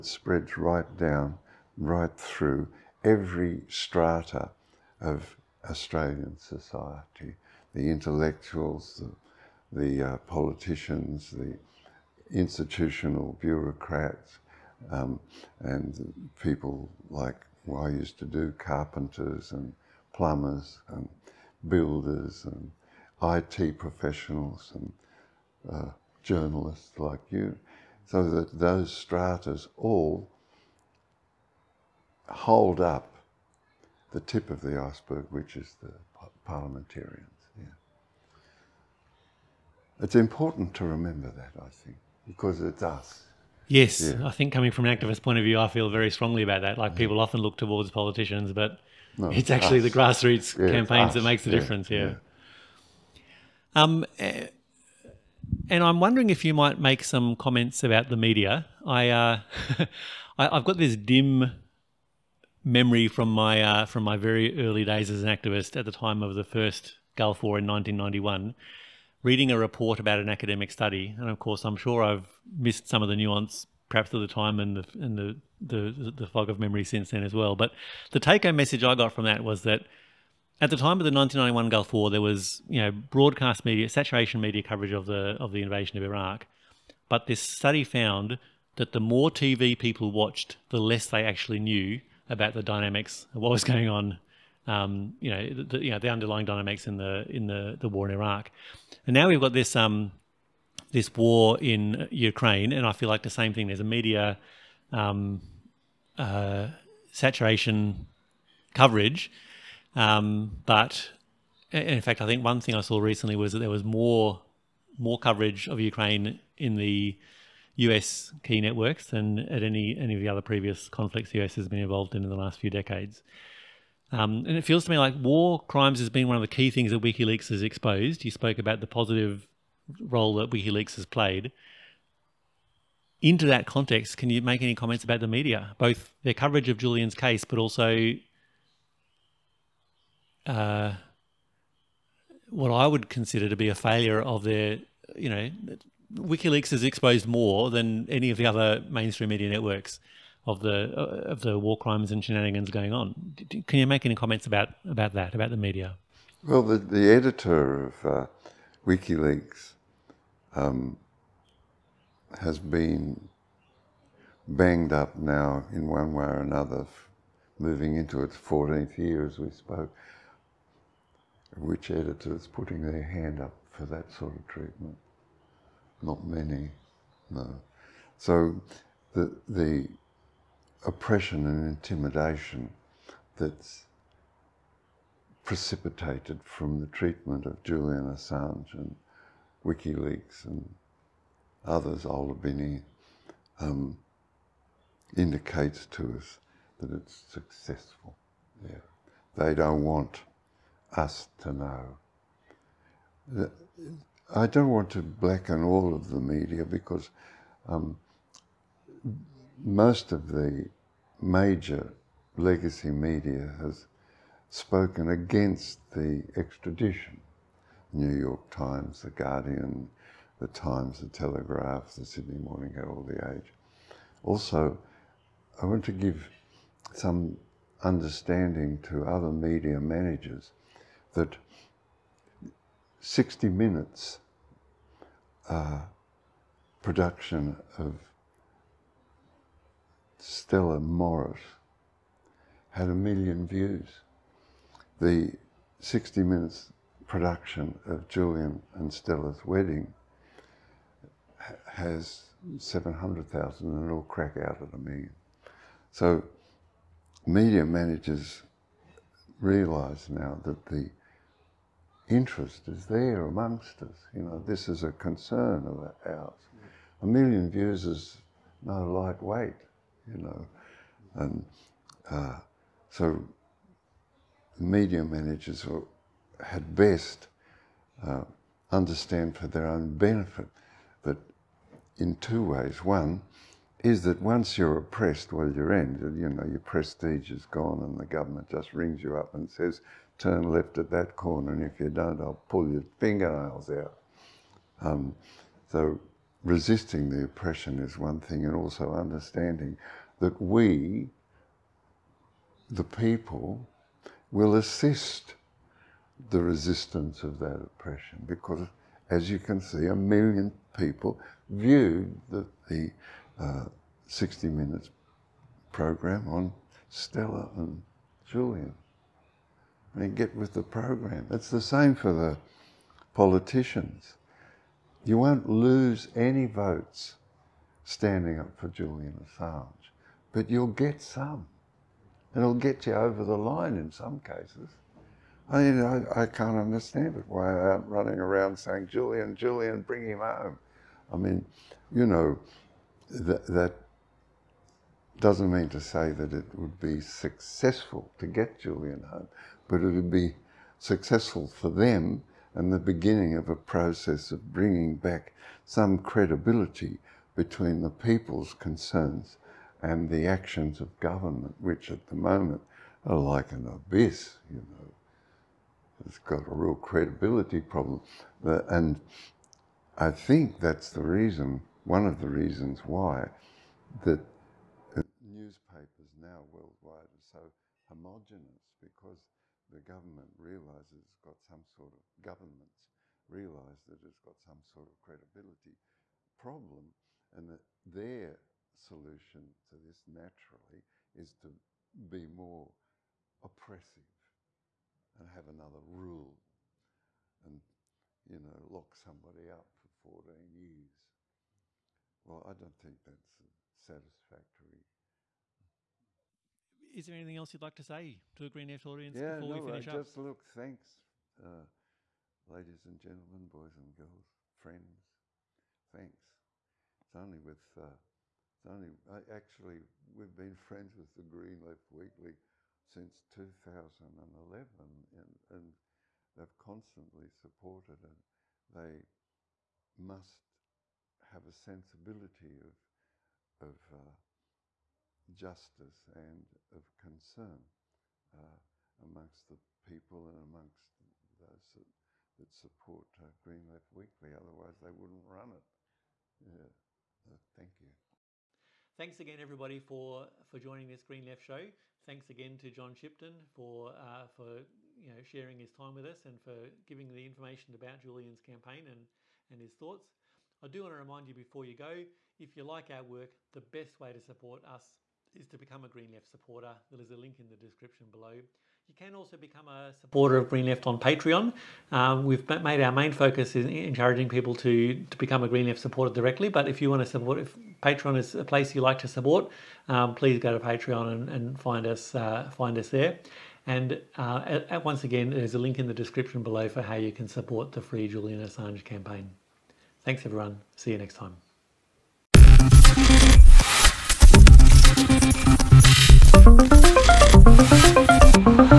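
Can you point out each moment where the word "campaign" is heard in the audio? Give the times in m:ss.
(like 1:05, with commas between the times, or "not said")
0:50, 7:38, 8:08.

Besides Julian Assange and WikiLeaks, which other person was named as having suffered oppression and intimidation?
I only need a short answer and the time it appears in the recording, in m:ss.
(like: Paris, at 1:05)
Ola Bini, at 3:12.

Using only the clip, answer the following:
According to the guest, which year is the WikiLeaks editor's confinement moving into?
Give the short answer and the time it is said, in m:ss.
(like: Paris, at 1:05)
14th, at 2:48.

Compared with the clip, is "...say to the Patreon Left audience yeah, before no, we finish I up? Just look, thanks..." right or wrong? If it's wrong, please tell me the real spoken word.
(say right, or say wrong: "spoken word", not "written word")
wrong: "Green", not "Patreon".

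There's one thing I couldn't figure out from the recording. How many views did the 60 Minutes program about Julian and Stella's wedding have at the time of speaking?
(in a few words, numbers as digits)
700,000.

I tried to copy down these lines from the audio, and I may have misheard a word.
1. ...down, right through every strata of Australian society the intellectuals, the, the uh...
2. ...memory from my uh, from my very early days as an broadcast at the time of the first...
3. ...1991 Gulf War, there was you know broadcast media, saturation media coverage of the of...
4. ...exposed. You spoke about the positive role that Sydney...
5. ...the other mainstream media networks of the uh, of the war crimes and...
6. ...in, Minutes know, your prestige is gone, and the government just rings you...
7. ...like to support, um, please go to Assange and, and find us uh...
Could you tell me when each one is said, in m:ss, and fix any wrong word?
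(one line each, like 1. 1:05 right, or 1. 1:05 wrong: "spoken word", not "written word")
1. 0:00 right
2. 1:02 wrong: "activist", not "broadcast"
3. 1:21 right
4. 2:07 wrong: "WikiLeaks", not "Sydney"
5. 2:28 right
6. 4:45 wrong: "You", not "Minutes"
7. 7:58 wrong: "Patreon", not "Assange".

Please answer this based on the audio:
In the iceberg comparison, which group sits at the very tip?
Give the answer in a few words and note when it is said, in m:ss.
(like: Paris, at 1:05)
parliamentarians, at 0:36.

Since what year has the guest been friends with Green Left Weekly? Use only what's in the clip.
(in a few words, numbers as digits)
2011.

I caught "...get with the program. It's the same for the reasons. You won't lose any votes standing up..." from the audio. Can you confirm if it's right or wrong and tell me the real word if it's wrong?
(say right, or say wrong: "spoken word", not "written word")
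wrong: "politicians", not "reasons".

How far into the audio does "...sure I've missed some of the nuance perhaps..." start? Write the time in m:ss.
1:11.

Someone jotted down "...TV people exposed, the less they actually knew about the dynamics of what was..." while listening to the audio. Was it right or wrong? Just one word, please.
wrong.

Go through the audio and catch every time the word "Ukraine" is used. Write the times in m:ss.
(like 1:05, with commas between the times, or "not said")
1:42, 1:55.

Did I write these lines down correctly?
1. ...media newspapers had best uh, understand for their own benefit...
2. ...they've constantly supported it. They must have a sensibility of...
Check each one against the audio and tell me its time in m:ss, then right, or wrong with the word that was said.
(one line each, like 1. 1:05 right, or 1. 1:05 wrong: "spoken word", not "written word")
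1. 4:34 wrong: "managers", not "newspapers"
2. 7:06 right.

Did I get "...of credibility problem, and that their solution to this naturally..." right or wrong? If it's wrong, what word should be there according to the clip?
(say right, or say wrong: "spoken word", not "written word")
right.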